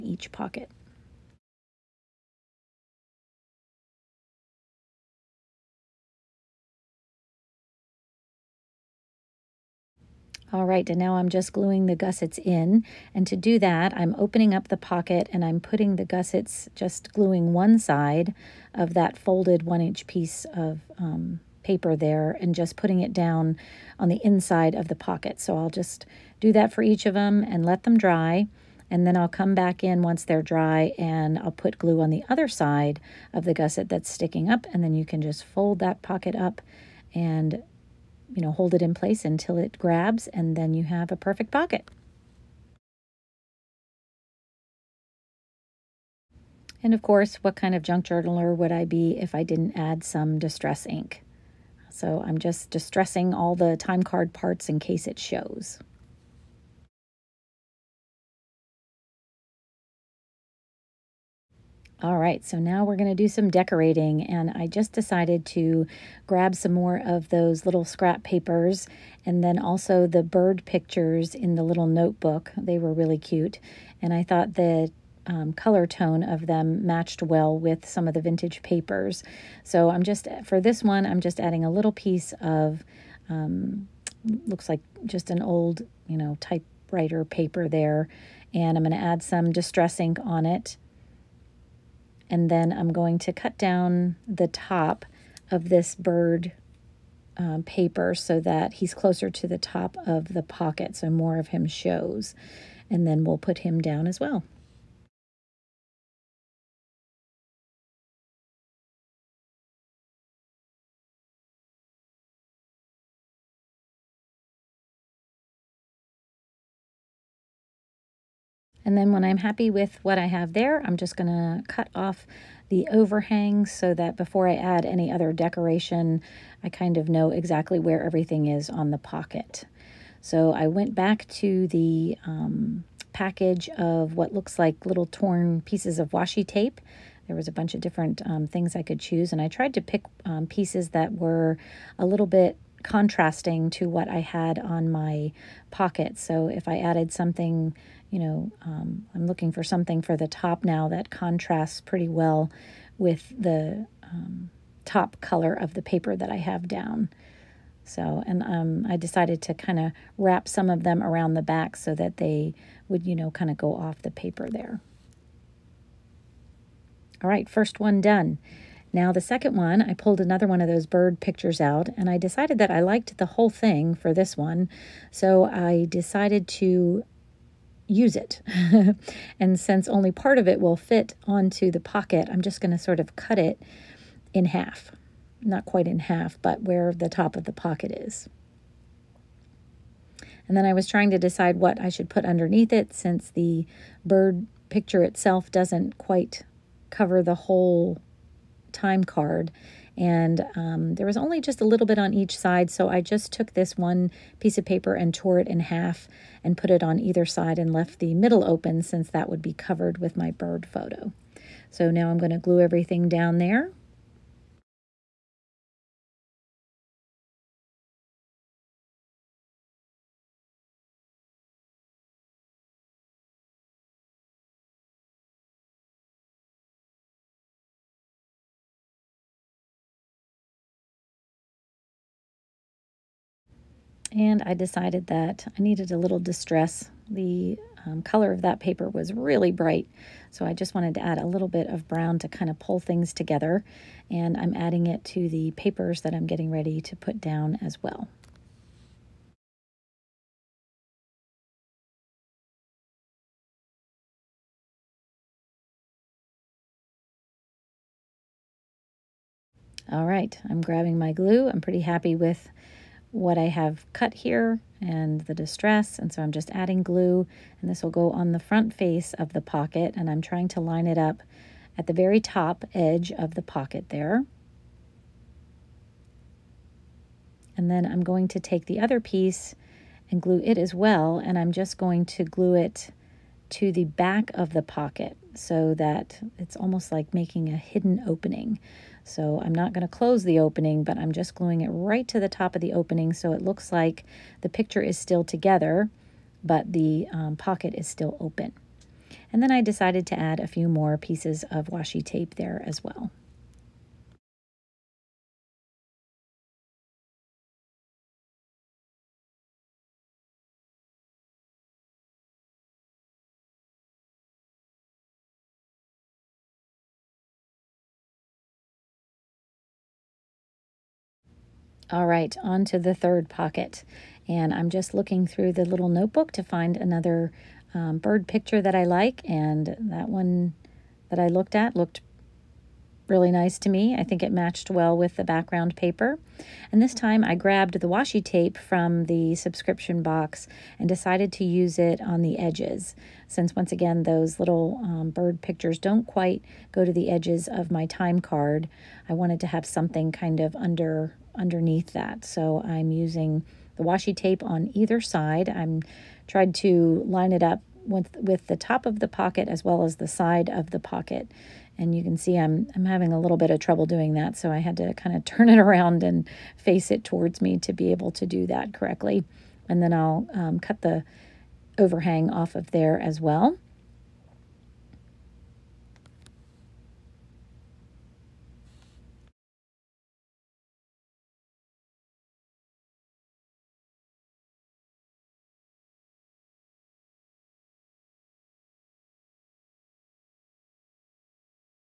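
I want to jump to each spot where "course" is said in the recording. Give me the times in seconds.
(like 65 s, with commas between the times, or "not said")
47 s.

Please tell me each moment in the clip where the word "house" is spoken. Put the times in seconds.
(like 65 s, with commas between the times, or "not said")
not said.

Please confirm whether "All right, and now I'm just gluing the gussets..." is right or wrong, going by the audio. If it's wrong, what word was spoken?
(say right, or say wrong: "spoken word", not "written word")
right.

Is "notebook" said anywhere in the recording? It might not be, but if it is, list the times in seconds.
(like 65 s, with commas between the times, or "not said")
71 s, 325 s.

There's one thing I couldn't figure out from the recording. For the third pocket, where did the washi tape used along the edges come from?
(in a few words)
Subscription box.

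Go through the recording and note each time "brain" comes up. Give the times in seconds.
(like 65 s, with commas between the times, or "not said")
not said.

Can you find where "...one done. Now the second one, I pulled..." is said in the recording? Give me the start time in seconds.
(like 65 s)
167 s.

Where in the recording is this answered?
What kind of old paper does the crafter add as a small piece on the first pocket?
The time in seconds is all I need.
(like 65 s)
86 s.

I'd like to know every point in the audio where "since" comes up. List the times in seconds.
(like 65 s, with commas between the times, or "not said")
179 s, 192 s, 208 s, 343 s.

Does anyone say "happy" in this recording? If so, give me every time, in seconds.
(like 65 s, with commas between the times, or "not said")
119 s, 261 s.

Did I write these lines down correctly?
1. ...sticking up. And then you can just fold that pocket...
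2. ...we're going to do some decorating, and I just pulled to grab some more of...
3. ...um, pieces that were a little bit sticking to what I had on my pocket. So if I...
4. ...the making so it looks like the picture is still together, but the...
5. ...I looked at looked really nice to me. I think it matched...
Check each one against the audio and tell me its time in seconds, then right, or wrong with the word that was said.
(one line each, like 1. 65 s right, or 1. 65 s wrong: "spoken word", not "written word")
1. 34 s right
2. 62 s wrong: "decided", not "pulled"
3. 140 s wrong: "contrasting", not "sticking"
4. 292 s wrong: "opening", not "making"
5. 331 s right.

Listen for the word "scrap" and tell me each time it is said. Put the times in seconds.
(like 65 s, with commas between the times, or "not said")
67 s.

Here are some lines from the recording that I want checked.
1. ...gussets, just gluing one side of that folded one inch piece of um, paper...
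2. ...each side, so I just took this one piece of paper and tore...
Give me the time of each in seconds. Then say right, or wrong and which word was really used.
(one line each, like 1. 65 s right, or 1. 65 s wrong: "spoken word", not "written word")
1. 16 s right
2. 202 s right.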